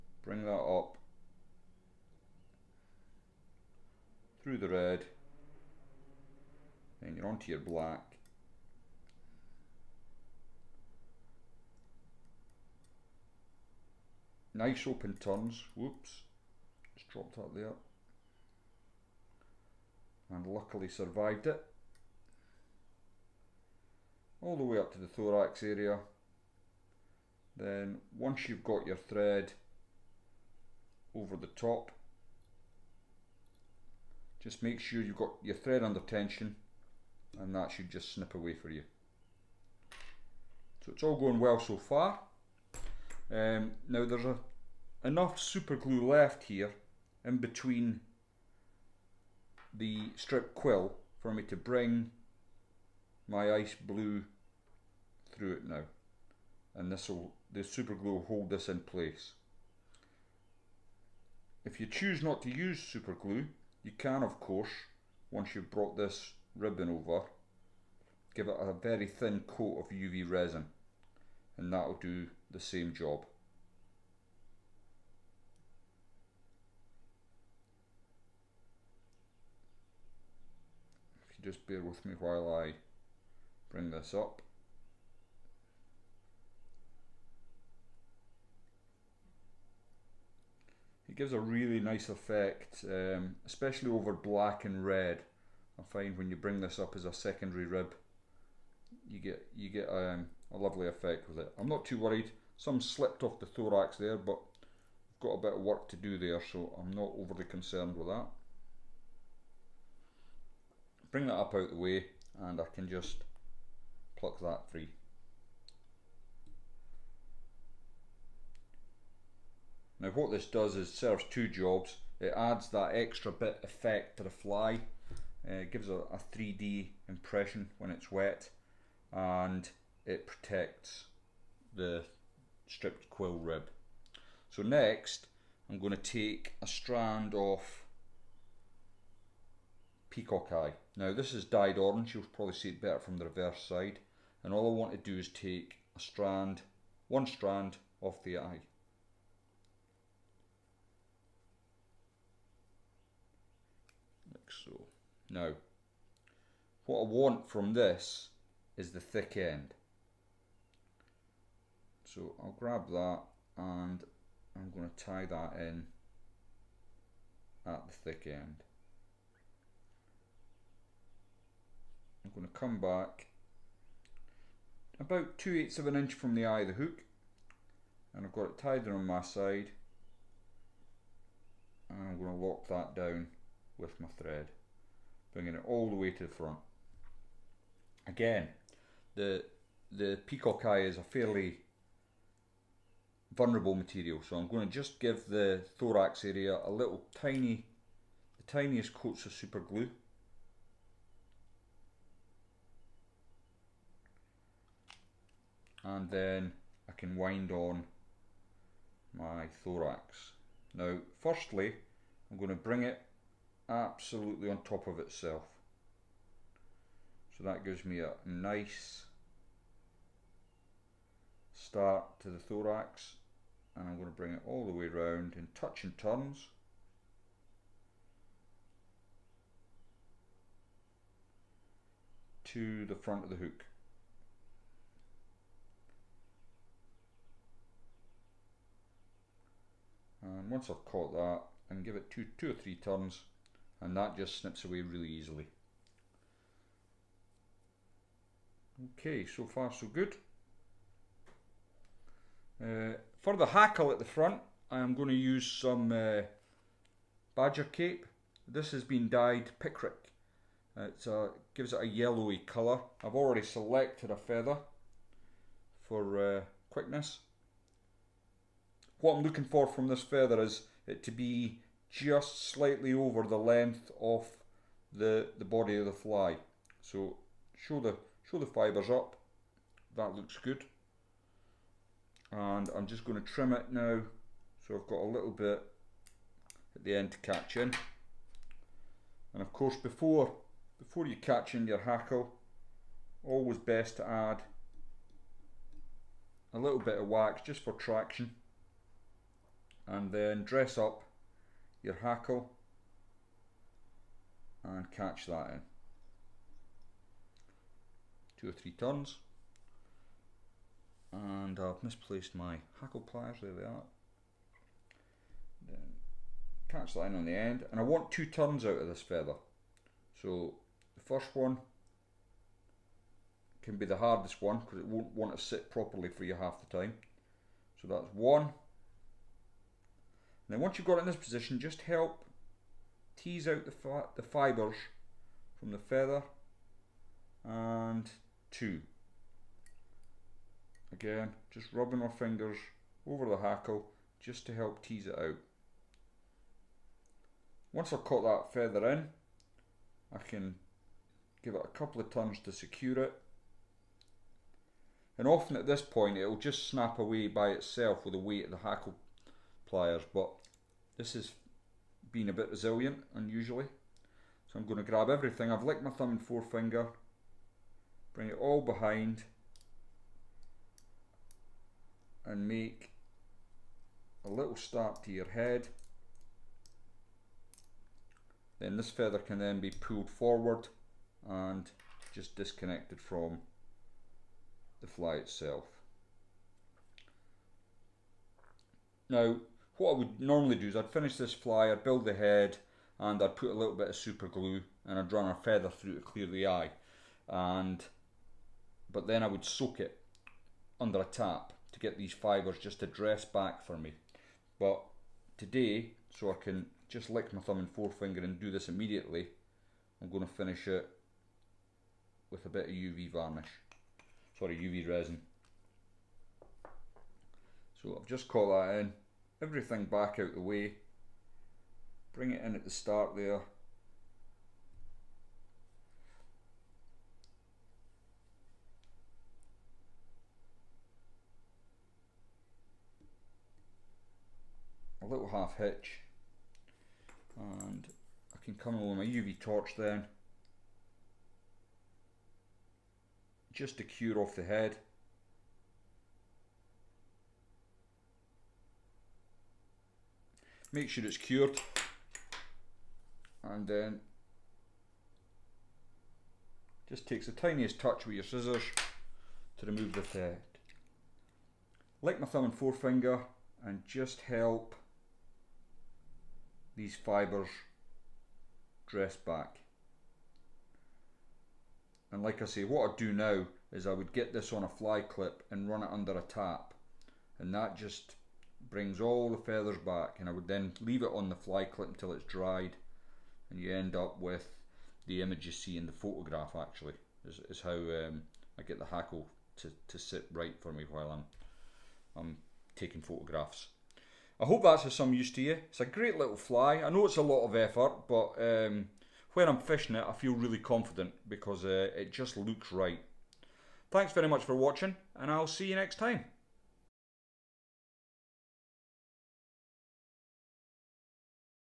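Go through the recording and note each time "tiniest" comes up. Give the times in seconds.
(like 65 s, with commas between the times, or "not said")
198 s, 457 s.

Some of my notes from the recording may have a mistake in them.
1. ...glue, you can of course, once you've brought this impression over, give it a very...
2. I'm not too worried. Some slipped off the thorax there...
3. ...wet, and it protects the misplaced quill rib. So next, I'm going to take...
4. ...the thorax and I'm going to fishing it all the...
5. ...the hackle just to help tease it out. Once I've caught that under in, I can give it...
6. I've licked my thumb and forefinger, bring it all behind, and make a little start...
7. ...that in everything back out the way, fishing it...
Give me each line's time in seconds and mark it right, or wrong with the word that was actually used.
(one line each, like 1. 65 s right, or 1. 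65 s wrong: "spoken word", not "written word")
1. 63 s wrong: "ribbon", not "impression"
2. 101 s right
3. 128 s wrong: "stripped", not "misplaced"
4. 222 s wrong: "bring", not "fishing"
5. 343 s wrong: "feather", not "under"
6. 365 s right
7. 418 s wrong: "bring", not "fishing".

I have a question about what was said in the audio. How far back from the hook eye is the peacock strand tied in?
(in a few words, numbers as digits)
2 eighths of an inch.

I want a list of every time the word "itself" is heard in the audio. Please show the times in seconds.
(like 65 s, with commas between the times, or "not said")
214 s, 357 s, 385 s.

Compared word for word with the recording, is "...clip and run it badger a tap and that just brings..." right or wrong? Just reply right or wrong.
wrong.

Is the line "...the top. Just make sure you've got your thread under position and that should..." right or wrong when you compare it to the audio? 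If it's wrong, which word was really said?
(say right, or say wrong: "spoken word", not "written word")
wrong: "tension", not "position".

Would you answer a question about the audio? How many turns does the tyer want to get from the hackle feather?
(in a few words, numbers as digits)
2.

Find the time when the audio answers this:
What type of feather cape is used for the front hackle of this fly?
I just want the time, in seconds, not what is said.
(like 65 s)
257 s.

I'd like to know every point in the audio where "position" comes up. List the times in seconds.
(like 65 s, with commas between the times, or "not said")
331 s.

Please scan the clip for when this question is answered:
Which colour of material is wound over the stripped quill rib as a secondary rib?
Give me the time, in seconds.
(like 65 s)
53 s.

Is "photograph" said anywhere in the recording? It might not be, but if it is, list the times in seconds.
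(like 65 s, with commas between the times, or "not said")
485 s, 493 s.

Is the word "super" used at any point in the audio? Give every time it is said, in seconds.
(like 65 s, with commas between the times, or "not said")
45 s, 57 s, 62 s, 199 s, 393 s.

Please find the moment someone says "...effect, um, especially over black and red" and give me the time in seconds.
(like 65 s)
92 s.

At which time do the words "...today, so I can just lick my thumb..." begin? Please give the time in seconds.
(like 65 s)
405 s.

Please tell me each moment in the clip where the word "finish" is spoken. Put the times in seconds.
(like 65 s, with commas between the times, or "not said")
390 s, 410 s.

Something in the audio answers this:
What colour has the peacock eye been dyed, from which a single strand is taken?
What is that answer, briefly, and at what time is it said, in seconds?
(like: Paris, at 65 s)
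Orange, at 141 s.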